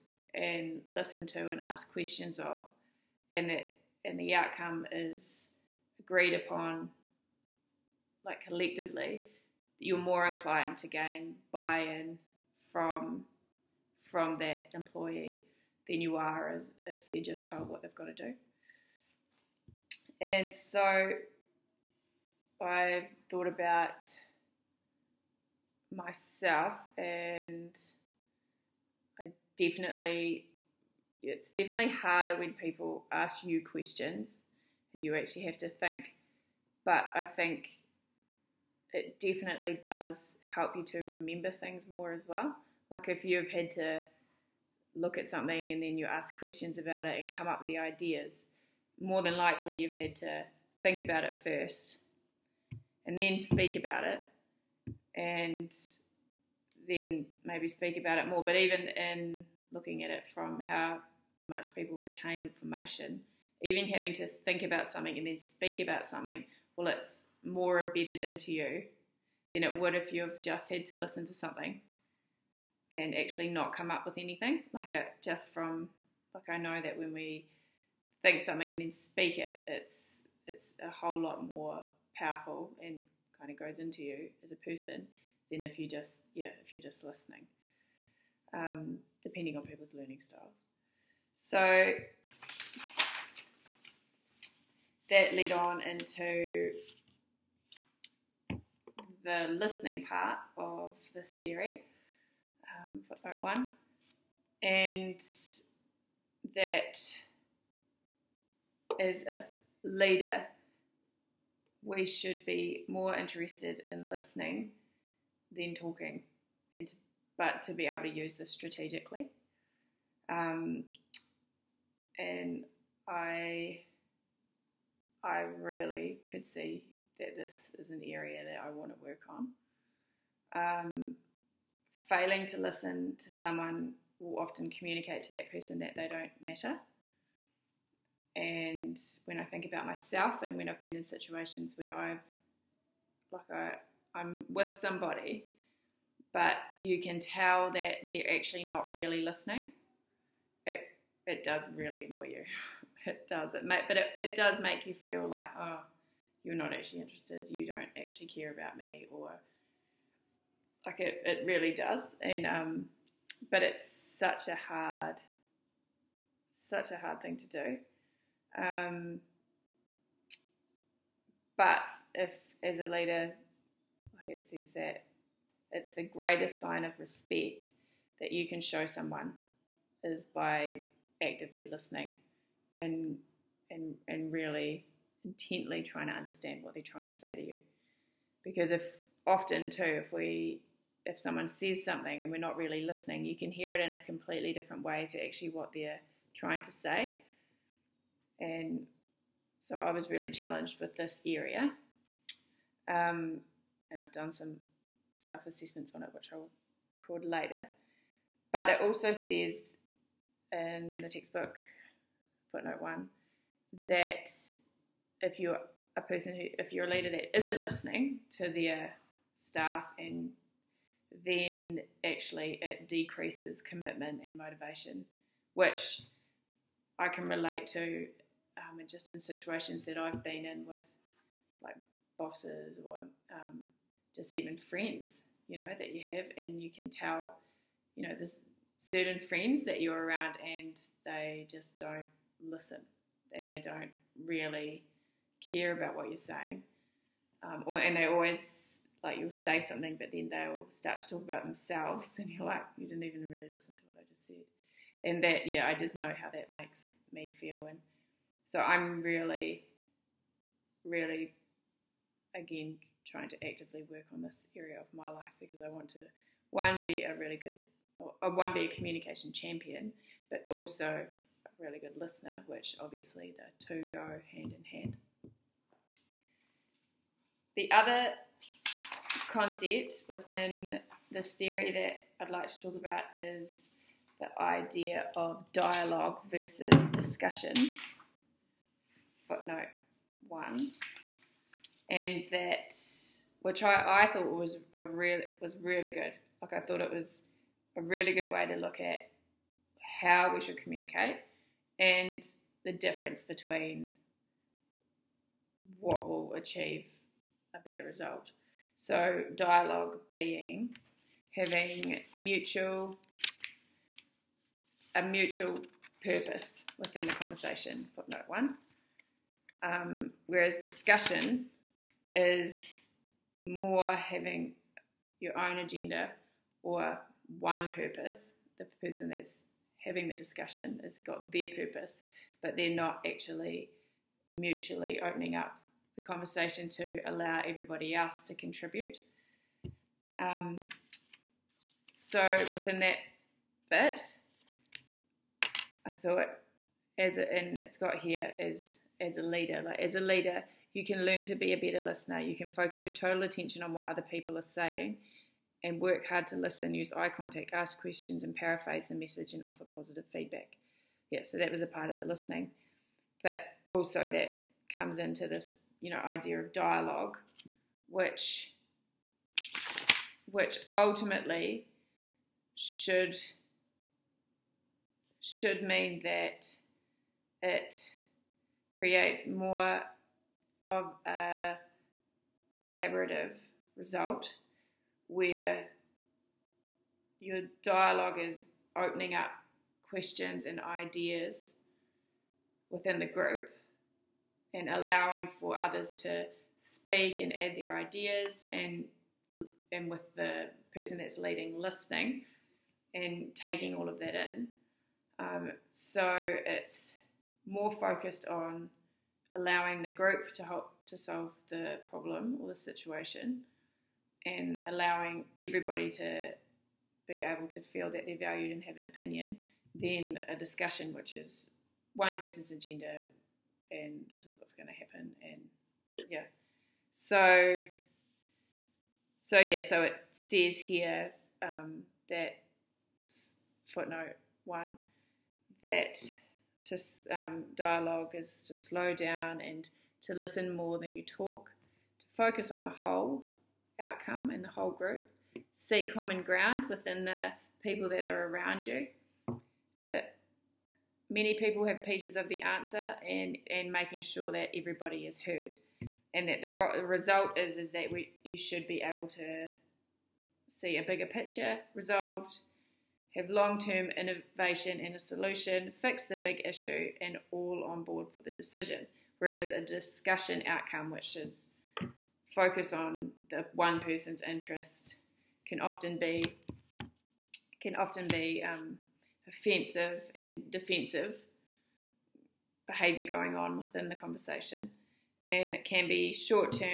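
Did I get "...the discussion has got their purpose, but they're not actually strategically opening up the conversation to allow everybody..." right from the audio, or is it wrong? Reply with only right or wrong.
wrong.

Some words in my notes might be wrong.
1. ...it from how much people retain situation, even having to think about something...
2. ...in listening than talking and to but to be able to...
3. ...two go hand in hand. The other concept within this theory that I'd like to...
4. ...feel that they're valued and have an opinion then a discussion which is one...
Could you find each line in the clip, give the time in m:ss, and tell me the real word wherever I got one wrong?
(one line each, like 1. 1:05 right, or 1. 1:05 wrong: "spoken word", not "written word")
1. 1:00 wrong: "information", not "situation"
2. 1:53 right
3. 4:33 right
4. 6:57 right.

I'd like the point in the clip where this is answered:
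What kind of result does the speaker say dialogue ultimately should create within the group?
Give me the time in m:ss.
6:22.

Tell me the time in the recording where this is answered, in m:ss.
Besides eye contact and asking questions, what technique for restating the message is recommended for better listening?
5:58.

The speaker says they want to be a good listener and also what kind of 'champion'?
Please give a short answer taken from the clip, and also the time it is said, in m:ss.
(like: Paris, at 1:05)
Communication champion, at 4:28.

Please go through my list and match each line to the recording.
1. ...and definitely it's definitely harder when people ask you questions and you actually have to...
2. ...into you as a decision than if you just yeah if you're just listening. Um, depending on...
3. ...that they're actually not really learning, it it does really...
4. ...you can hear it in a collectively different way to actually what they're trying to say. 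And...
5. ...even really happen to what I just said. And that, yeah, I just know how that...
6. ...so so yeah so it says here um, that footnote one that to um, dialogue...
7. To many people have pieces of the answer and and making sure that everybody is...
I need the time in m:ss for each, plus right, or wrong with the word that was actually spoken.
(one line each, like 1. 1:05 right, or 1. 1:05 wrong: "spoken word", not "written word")
1. 0:26 right
2. 1:23 wrong: "person", not "decision"
3. 2:27 wrong: "listening", not "learning"
4. 3:13 wrong: "completely", not "collectively"
5. 4:13 wrong: "listen", not "happen"
6. 7:06 right
7. 7:29 right.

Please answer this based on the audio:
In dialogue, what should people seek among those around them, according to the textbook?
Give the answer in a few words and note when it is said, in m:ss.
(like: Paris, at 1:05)
Common ground, at 7:25.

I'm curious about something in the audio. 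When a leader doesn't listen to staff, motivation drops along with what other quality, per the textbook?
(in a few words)
Commitment.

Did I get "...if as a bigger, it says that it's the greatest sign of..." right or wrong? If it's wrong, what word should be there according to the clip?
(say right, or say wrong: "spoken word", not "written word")
wrong: "leader", not "bigger".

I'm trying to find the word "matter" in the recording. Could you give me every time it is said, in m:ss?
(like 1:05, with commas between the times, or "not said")
2:16.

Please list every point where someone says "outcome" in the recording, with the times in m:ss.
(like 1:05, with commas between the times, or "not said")
0:04, 7:23, 7:50.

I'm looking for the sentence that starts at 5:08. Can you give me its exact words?
So dialogue being having mutual a mutual purpose within the conversation, footnote one.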